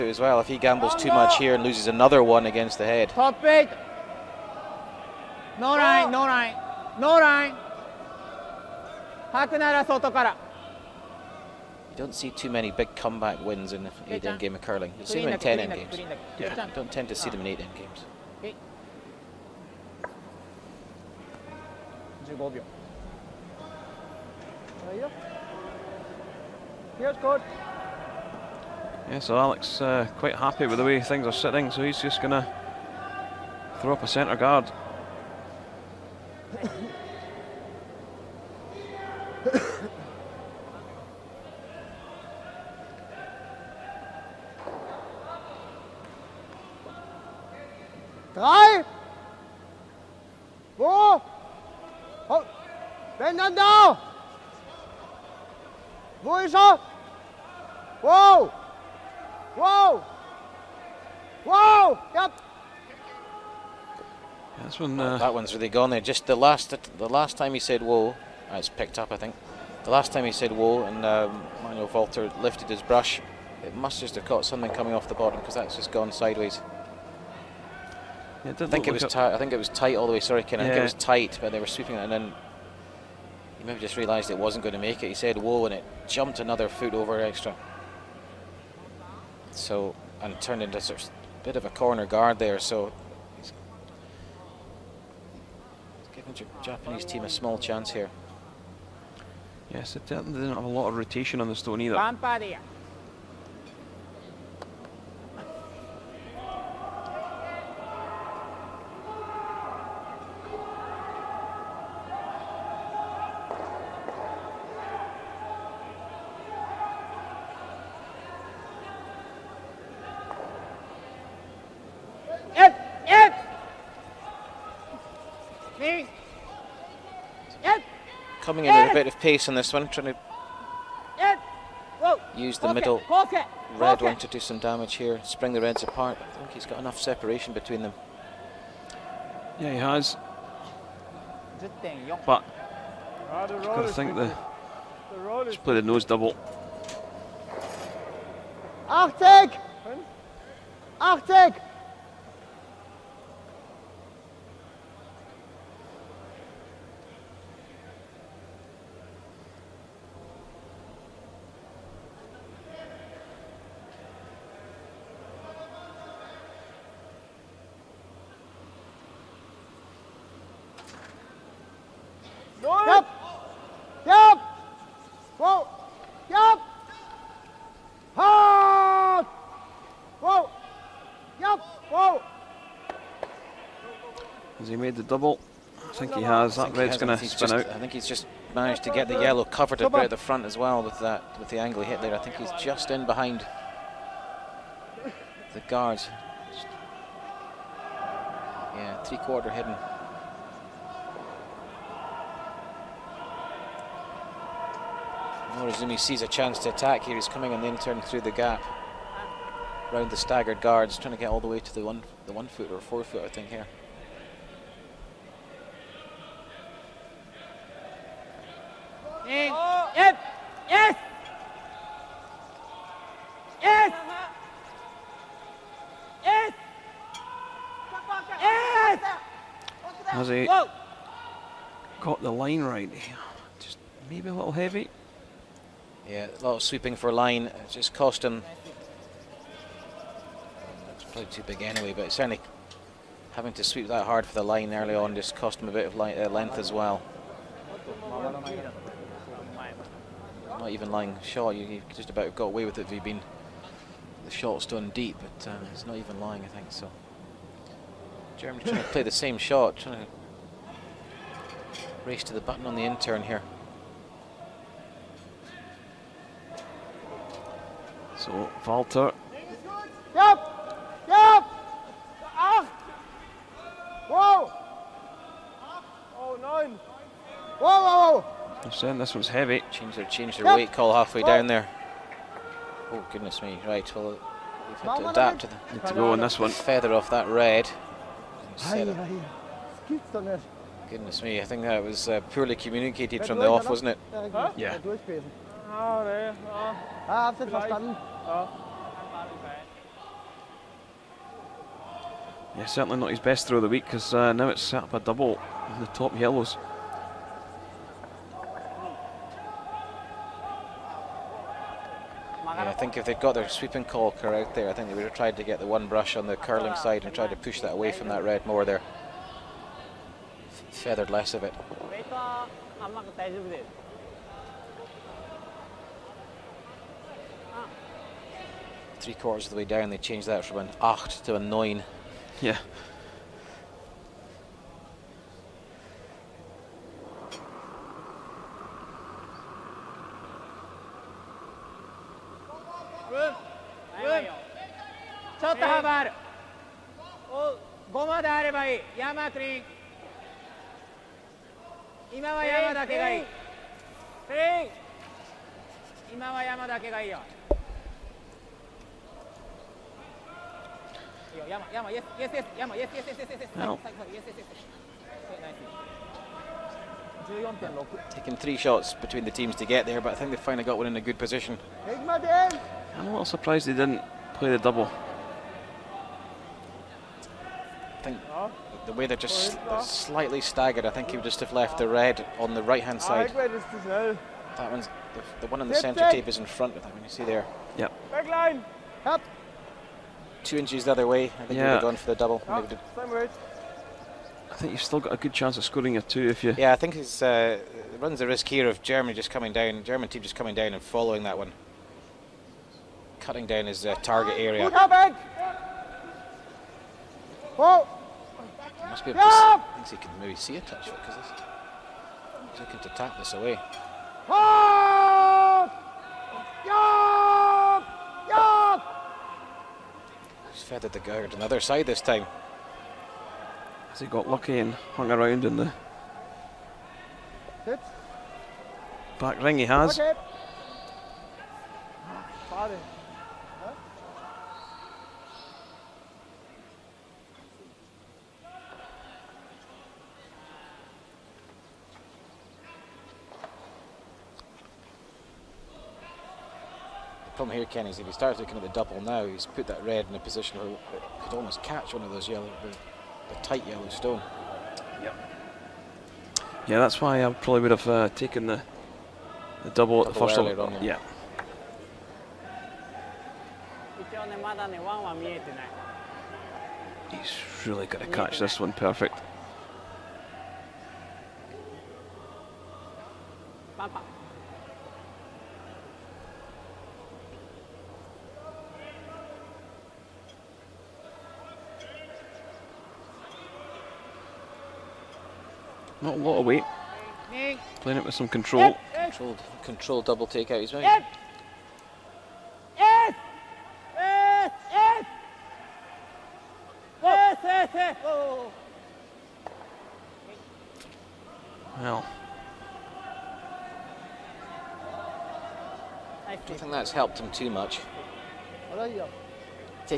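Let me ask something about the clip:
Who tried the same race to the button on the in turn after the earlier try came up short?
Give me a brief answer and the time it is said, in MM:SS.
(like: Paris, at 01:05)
Jeremy, at 04:18.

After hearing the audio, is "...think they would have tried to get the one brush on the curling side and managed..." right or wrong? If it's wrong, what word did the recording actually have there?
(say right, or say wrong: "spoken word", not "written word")
wrong: "tried", not "managed".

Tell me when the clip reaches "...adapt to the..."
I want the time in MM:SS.
04:45.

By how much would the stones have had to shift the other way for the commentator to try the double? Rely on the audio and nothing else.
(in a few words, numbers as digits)
2 inches.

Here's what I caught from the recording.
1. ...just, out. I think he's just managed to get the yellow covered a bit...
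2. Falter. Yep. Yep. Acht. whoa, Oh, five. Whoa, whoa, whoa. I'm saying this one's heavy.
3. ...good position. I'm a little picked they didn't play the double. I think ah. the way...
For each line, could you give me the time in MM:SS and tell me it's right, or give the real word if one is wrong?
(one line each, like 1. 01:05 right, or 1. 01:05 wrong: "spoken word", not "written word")
1. 03:07 right
2. 04:28 wrong: "nine", not "five"
3. 06:11 wrong: "surprised", not "picked".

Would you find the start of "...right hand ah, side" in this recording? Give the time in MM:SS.
06:22.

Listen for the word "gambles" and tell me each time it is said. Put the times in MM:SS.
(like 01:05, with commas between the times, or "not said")
00:00.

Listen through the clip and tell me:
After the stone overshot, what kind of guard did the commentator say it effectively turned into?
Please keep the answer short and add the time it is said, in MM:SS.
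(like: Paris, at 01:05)
Corner guard, at 01:31.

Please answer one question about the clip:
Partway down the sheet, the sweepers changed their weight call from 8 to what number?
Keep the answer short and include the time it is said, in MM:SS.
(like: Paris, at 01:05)
9, at 05:31.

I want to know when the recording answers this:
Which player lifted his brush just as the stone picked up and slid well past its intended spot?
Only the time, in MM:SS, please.
01:11.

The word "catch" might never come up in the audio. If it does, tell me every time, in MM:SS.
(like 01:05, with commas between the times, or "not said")
07:31, 07:48.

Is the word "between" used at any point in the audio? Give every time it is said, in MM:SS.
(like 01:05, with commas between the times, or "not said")
02:17, 06:08.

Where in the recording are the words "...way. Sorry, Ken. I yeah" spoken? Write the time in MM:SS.
01:20.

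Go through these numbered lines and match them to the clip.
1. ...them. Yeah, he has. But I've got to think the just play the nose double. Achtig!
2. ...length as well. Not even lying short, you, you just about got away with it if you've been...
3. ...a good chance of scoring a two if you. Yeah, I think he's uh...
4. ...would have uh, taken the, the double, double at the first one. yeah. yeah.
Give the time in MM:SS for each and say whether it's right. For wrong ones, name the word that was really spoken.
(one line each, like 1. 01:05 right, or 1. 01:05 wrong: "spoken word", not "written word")
1. 02:17 right
2. 04:06 right
3. 06:35 right
4. 07:37 right.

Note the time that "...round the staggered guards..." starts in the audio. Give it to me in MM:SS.
03:29.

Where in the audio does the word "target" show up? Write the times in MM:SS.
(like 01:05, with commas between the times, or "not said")
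06:43.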